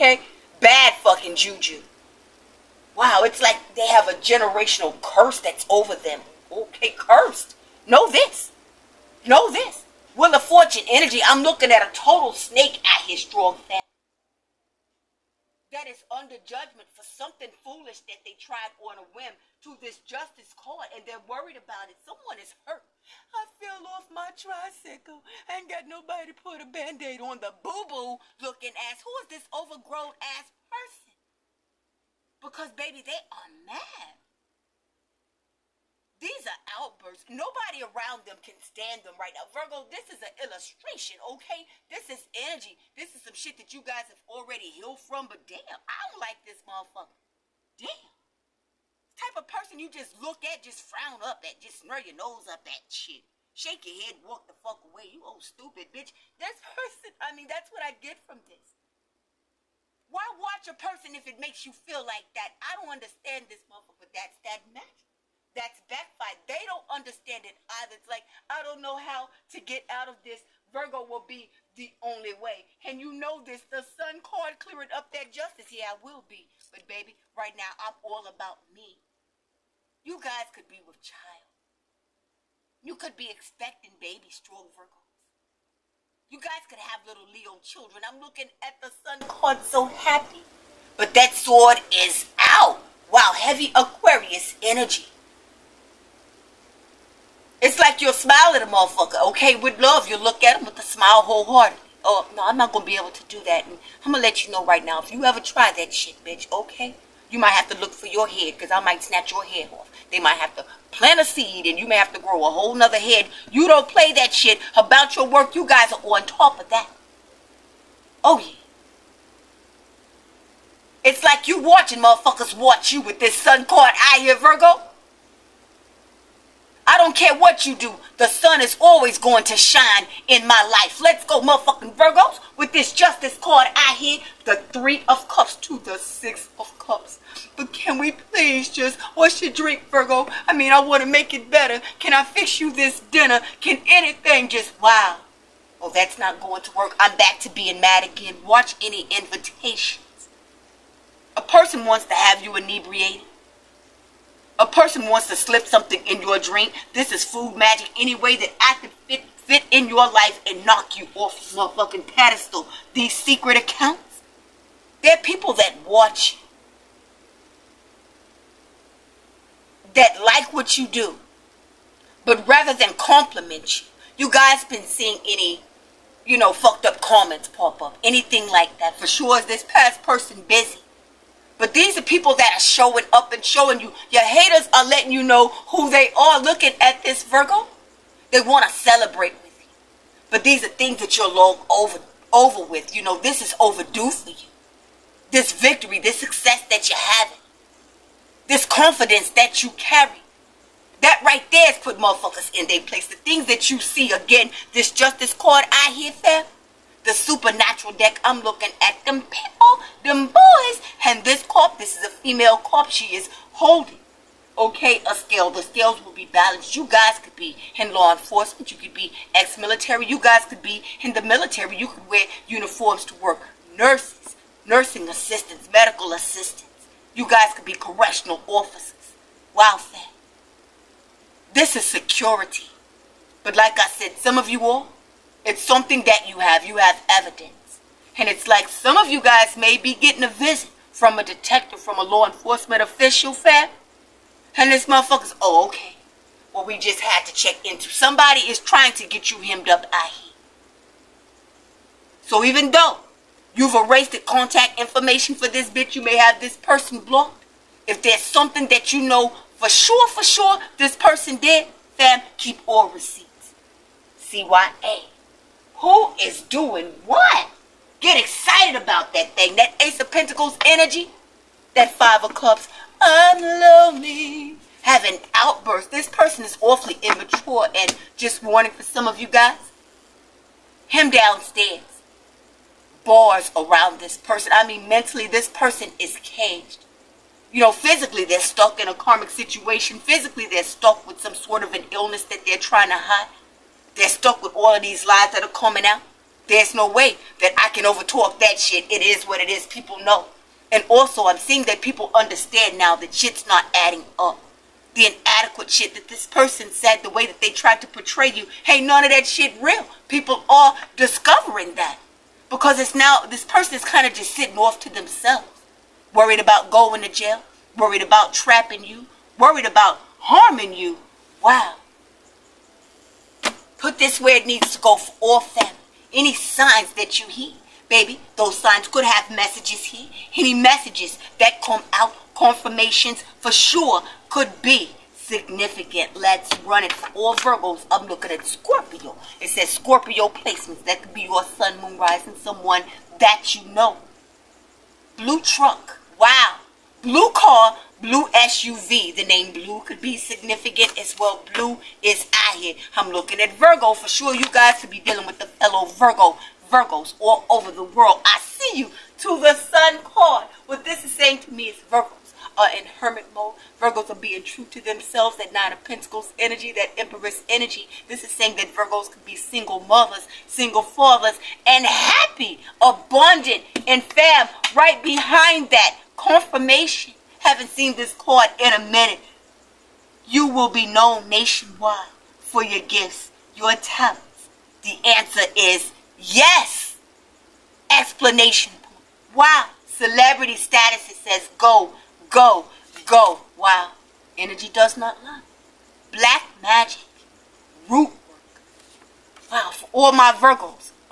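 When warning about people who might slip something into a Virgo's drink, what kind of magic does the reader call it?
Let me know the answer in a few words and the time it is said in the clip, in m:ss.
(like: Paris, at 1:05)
Food magic, at 2:37.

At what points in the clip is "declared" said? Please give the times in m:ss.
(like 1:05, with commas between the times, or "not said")
not said.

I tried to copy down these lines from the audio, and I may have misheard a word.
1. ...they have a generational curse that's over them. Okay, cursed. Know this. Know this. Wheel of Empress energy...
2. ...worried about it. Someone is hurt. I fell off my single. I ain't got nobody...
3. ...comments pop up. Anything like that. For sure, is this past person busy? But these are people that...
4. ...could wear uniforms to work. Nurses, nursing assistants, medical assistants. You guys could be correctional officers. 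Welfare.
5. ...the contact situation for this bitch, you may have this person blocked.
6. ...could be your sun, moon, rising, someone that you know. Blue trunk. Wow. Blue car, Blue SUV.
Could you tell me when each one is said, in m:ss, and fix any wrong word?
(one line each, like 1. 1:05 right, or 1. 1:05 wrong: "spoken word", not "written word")
1. 0:03 wrong: "Fortune", not "Empress"
2. 0:21 wrong: "tricycle", not "single"
3. 2:57 right
4. 3:41 right
5. 4:14 wrong: "information", not "situation"
6. 5:41 right.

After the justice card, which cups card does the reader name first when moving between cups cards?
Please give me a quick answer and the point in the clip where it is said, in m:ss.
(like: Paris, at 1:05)
Three of Cups, at 2:14.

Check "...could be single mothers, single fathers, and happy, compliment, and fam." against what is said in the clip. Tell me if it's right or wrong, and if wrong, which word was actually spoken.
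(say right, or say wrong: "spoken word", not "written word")
wrong: "abundant", not "compliment".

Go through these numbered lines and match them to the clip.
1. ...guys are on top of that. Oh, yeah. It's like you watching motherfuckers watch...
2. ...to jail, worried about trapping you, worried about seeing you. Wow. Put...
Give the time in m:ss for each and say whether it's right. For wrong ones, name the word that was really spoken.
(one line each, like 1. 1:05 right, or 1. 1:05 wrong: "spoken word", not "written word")
1. 1:55 right
2. 5:17 wrong: "harming", not "seeing".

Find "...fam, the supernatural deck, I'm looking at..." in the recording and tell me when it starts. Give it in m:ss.
3:26.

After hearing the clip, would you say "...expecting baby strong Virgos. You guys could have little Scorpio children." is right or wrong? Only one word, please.
wrong.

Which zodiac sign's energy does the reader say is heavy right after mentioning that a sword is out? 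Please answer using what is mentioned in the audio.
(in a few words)
Aquarius.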